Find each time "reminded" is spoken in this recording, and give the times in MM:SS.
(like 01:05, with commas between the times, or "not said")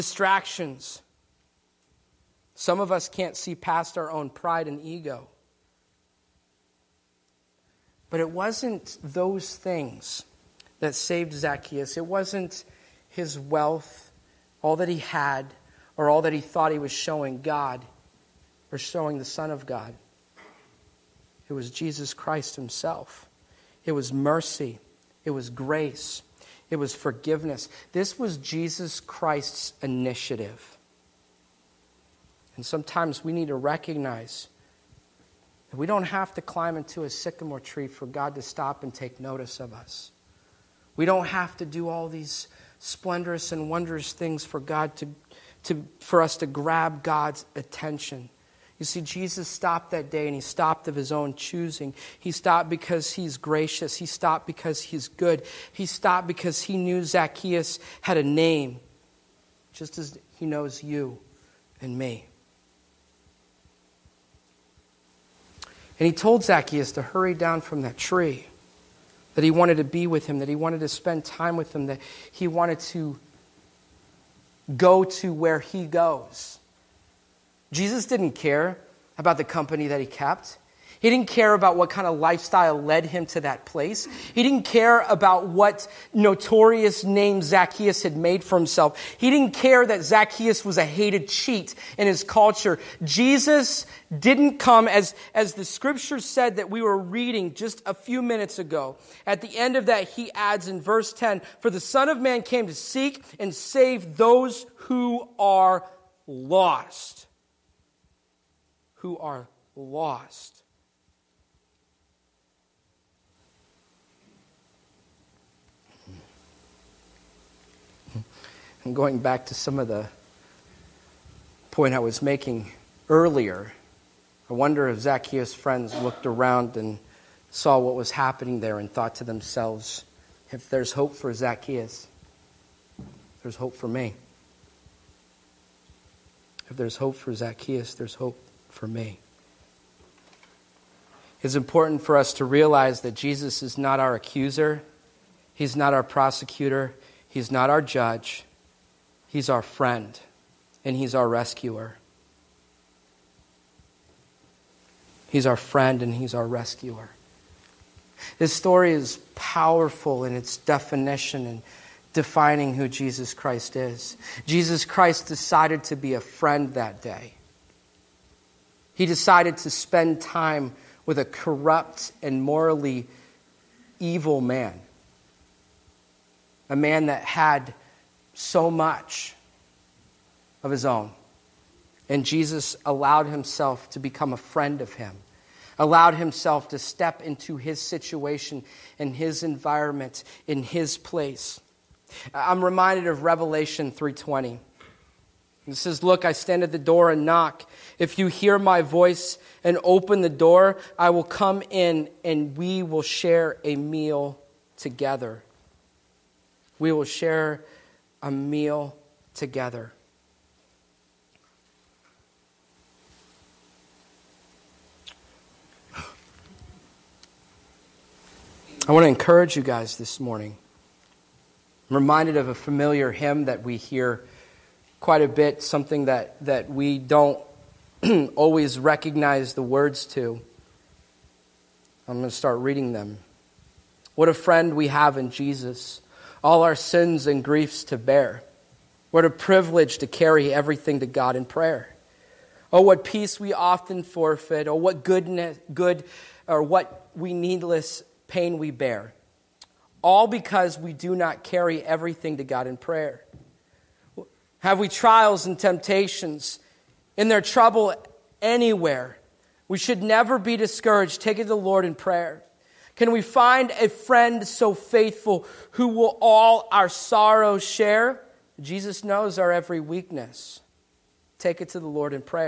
03:12, 03:41.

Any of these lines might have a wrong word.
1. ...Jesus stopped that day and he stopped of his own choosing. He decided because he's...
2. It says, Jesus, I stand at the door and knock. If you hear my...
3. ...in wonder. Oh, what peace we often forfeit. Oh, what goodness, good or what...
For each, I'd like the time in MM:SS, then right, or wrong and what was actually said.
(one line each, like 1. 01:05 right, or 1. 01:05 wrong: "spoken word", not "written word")
1. 00:49 wrong: "stopped", not "decided"
2. 03:15 wrong: "Look", not "Jesus"
3. 04:01 wrong: "prayer", not "wonder".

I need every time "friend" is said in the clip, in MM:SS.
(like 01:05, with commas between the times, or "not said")
02:05, 02:29, 02:35, 02:46, 03:04, 03:54, 04:23.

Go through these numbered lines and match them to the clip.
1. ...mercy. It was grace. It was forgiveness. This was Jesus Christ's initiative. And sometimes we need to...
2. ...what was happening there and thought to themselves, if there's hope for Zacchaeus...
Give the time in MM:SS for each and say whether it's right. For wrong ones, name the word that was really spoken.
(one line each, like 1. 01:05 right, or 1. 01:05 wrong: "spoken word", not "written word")
1. 00:24 right
2. 02:07 right.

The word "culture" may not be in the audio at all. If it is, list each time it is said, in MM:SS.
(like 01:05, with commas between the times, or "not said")
01:32.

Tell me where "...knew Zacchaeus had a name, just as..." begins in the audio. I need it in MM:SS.
00:56.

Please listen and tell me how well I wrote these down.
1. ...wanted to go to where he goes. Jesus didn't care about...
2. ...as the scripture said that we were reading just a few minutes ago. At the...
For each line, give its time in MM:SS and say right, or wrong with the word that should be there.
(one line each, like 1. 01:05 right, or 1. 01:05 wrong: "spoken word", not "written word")
1. 01:12 right
2. 01:35 right.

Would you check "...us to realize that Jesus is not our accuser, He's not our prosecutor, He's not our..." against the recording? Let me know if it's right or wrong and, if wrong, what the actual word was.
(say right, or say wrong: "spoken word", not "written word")
right.